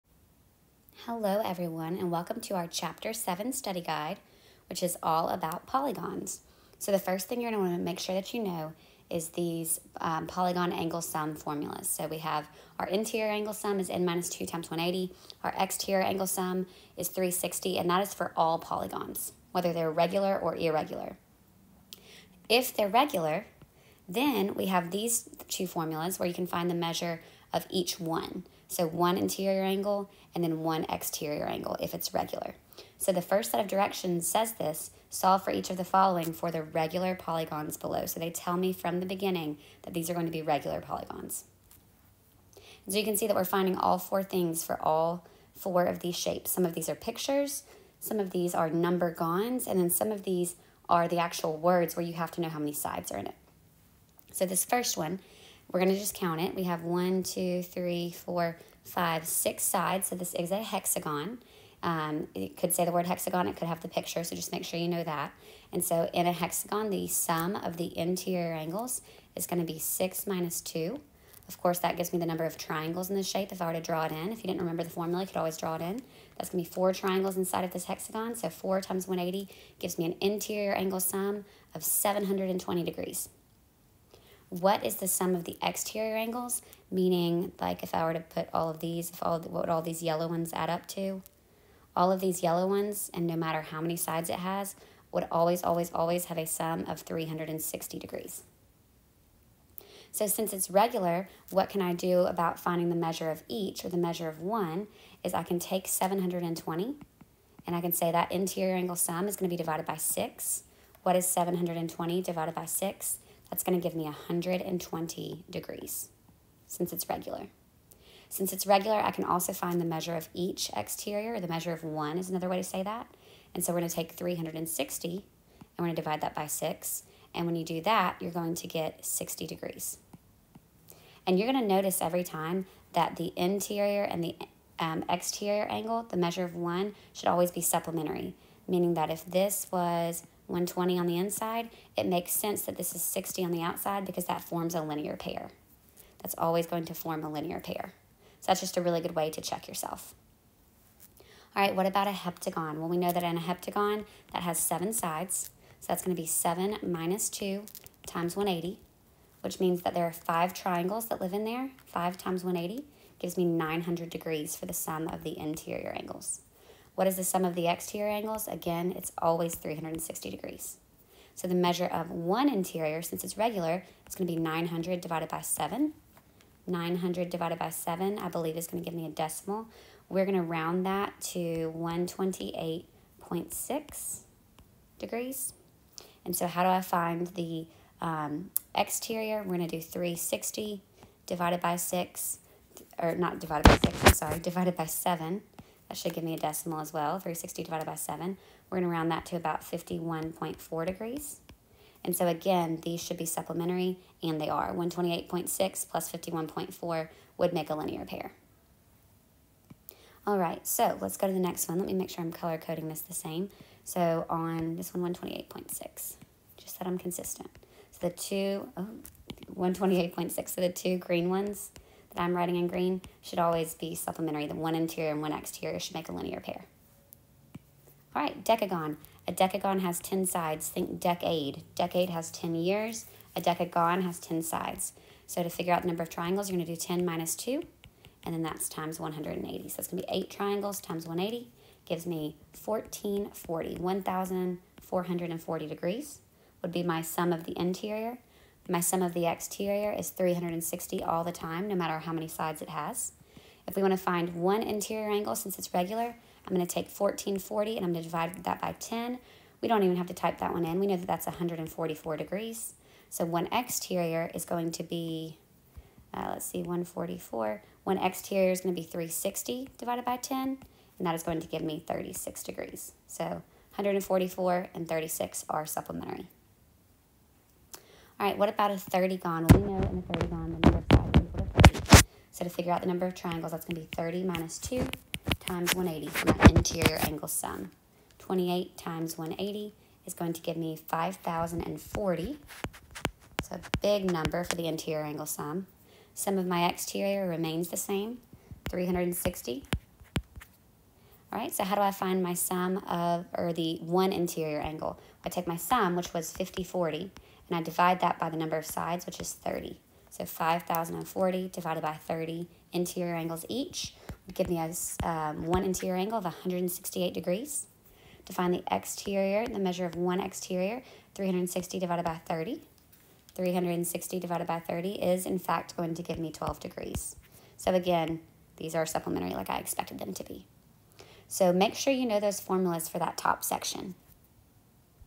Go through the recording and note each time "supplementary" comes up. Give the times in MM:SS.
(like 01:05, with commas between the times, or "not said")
02:17, 03:23, 03:43, 04:35, 05:28.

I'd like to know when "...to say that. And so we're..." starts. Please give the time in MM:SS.
02:02.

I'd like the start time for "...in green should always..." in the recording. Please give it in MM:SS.
03:42.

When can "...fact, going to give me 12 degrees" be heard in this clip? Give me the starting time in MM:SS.
05:25.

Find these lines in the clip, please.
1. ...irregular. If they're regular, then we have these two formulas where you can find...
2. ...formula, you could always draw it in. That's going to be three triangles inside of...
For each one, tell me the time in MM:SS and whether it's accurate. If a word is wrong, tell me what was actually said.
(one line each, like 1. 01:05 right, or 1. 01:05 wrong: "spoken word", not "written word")
1. 00:20 right
2. 01:14 wrong: "four", not "three".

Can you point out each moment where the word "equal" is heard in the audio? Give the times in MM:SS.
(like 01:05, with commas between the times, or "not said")
04:41.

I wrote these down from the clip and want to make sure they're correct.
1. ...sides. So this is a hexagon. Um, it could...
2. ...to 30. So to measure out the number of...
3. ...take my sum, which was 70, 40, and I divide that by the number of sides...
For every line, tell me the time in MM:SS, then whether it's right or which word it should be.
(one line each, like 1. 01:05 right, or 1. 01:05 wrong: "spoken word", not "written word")
1. 00:59 right
2. 04:41 wrong: "figure", not "measure"
3. 05:05 wrong: "50", not "70".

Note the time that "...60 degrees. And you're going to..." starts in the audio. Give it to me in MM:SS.
02:09.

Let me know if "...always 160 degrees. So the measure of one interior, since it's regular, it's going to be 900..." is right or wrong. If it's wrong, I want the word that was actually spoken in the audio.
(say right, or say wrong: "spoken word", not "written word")
wrong: "360", not "160".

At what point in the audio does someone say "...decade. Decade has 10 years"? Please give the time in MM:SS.
03:50.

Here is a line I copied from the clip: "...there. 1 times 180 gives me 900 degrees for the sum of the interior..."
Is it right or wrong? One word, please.
wrong.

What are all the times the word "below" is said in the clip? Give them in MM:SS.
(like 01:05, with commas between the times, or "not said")
00:37.